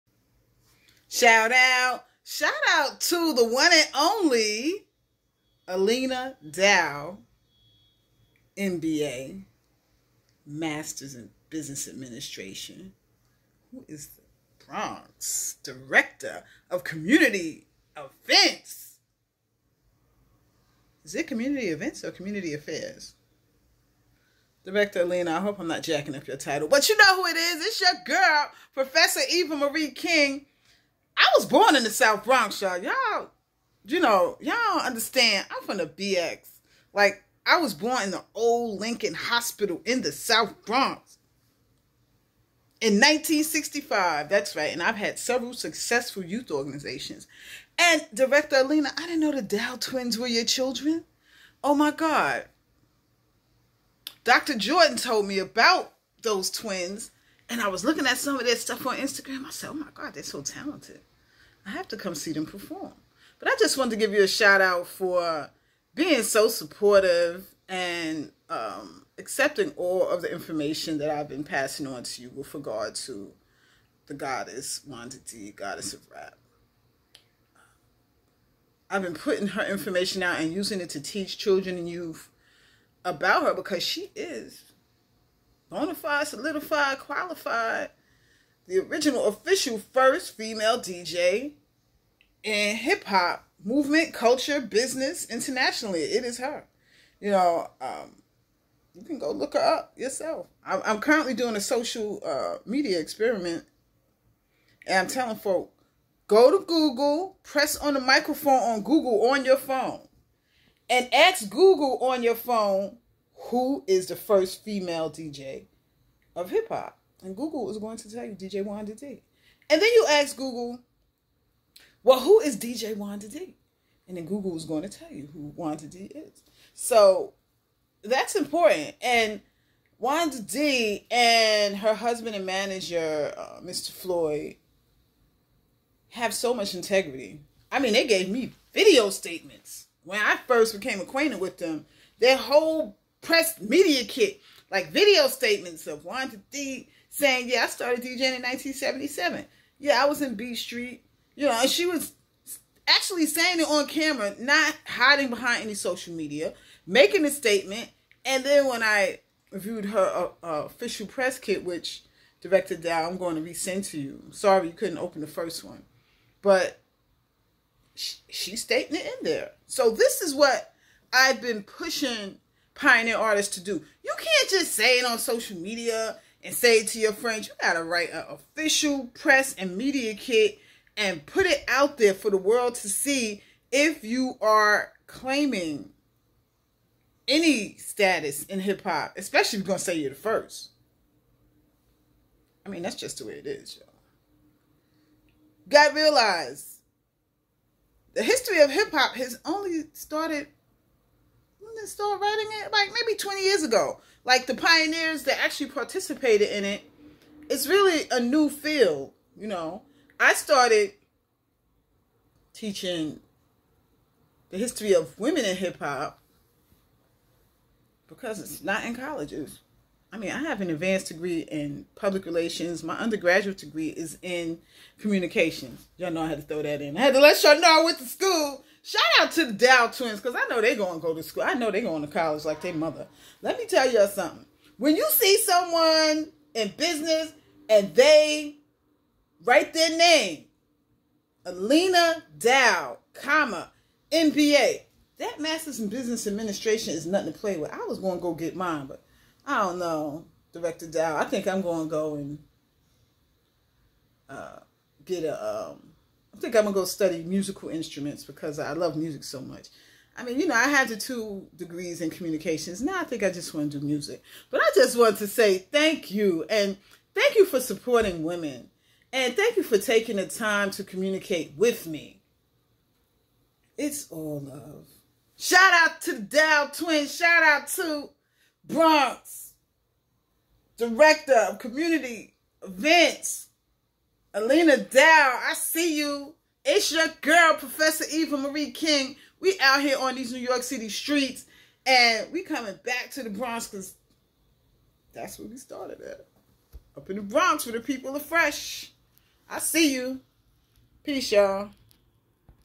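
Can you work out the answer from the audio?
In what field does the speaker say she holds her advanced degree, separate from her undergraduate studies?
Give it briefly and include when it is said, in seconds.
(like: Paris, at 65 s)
Public relations, at 221 s.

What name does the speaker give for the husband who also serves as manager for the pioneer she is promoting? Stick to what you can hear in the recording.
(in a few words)
Mr. Floyd.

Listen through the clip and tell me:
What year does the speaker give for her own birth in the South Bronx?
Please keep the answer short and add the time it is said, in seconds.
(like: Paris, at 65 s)
1965, at 42 s.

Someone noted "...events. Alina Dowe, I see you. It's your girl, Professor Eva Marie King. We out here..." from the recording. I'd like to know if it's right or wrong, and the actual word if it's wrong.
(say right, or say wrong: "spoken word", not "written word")
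right.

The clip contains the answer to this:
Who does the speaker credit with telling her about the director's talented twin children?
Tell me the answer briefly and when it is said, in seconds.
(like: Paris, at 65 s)
Dr. Jordan, at 54 s.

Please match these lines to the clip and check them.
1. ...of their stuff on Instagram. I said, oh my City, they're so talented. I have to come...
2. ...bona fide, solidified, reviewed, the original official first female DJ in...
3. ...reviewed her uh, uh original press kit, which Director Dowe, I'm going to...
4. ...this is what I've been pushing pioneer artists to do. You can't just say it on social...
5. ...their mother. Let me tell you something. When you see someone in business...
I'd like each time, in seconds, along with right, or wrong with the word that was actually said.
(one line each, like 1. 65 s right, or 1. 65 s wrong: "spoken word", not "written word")
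1. 58 s wrong: "God", not "City"
2. 85 s wrong: "qualified", not "reviewed"
3. 159 s wrong: "official", not "original"
4. 169 s right
5. 232 s right.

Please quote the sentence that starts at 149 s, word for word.
Yeah, I was in B Street.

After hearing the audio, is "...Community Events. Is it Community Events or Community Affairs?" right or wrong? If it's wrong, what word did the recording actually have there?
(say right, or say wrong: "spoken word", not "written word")
right.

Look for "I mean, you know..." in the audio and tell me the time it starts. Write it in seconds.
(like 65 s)
260 s.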